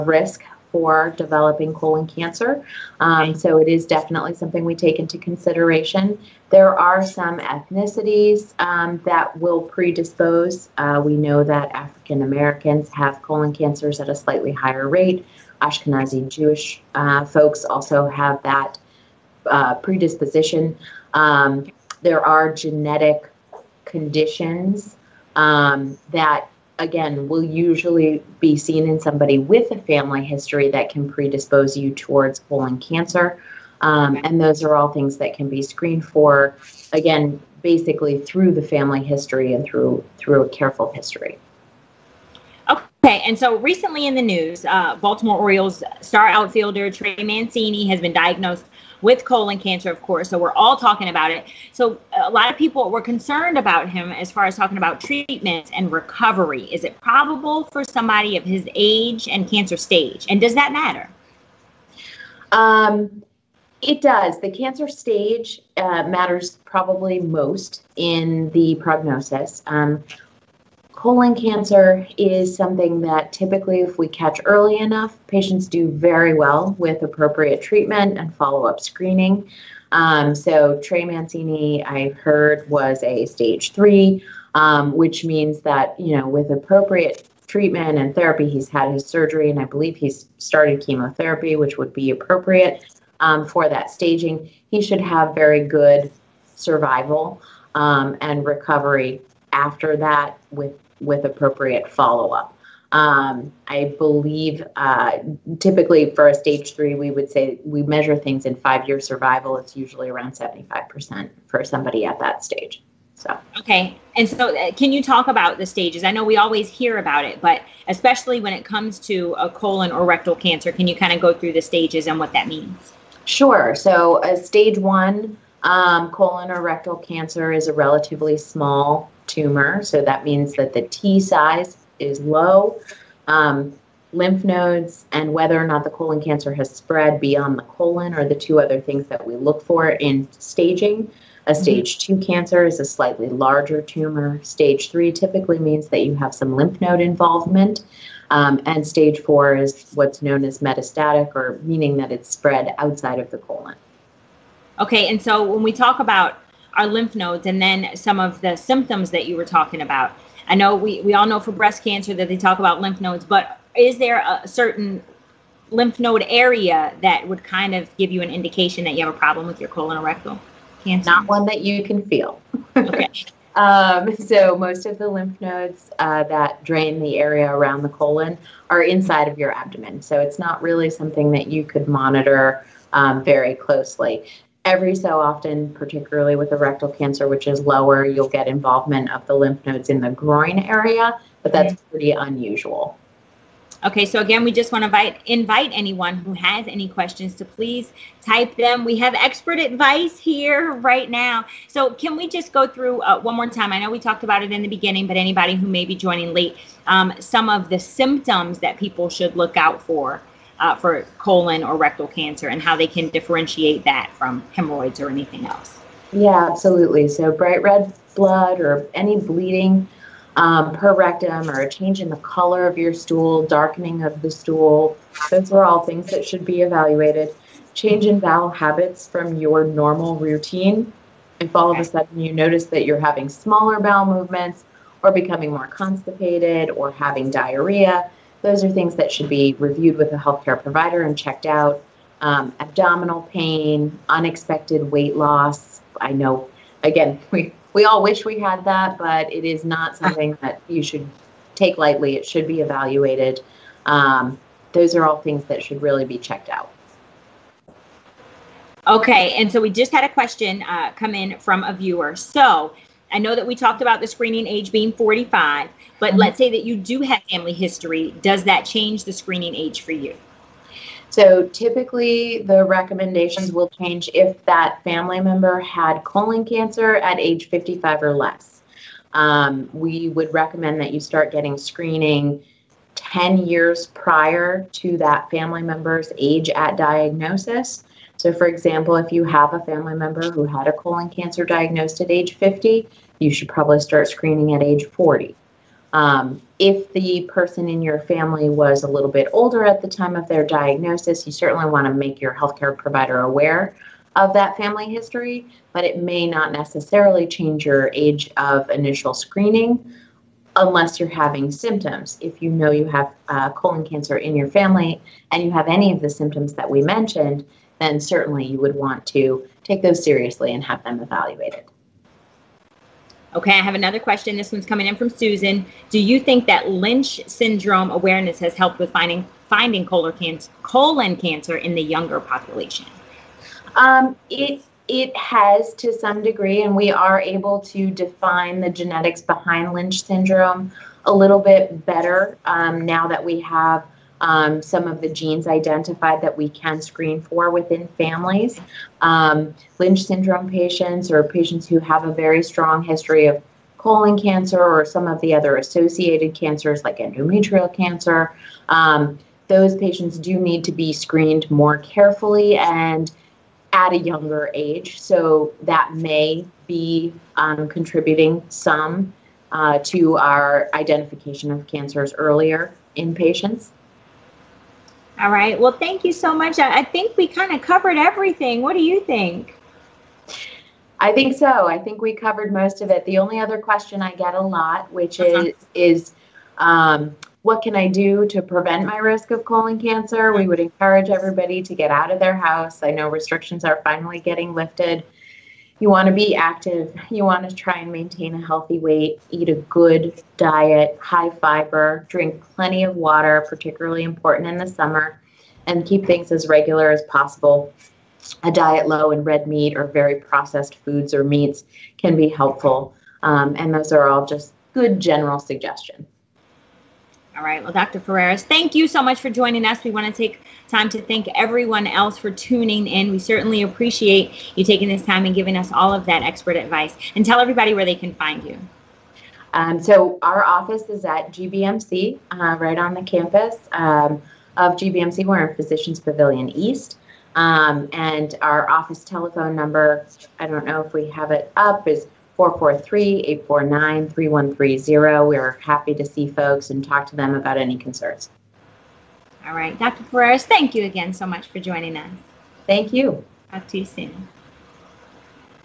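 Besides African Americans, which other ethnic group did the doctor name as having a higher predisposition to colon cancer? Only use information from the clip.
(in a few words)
Ashkenazi Jewish.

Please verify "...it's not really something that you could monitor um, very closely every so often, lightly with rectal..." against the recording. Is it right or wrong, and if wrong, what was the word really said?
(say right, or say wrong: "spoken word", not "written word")
wrong: "particularly", not "lightly".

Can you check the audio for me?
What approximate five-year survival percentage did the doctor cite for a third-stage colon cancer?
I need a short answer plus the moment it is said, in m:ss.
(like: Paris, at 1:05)
75%, at 1:50.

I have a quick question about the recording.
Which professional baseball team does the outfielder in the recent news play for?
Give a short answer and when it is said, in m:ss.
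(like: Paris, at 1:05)
Baltimore Orioles, at 0:44.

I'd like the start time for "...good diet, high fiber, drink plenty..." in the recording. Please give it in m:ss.
6:39.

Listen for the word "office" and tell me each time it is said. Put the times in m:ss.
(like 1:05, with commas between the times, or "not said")
7:10, 7:18.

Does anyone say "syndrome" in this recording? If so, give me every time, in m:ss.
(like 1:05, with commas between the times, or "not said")
5:27, 5:40, 5:50.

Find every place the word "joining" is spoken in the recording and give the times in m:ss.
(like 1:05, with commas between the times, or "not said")
3:25, 6:59, 7:31.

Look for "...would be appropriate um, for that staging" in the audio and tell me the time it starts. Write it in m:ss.
1:31.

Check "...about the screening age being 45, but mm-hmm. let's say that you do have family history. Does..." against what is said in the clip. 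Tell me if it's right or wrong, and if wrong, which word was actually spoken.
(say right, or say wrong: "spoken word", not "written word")
right.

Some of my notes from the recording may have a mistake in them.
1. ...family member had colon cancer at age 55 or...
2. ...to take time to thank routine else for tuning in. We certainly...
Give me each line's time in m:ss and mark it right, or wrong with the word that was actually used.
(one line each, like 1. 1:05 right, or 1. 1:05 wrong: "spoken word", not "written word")
1. 4:34 right
2. 7:00 wrong: "everyone", not "routine".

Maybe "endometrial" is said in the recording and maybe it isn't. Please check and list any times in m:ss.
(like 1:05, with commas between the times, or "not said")
5:56.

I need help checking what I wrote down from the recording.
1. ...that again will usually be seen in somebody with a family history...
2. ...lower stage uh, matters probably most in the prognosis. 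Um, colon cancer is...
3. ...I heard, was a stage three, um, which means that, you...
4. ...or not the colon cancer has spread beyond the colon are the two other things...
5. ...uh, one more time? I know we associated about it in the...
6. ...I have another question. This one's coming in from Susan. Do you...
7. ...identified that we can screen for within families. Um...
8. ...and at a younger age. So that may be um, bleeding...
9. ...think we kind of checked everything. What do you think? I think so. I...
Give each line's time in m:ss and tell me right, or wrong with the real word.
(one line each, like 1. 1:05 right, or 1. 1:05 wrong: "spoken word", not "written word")
1. 0:26 right
2. 1:04 wrong: "cancer", not "lower"
3. 1:21 right
4. 2:15 right
5. 3:23 wrong: "talked", not "associated"
6. 5:23 right
7. 5:45 right
8. 6:02 wrong: "contributing", not "bleeding"
9. 6:16 wrong: "covered", not "checked".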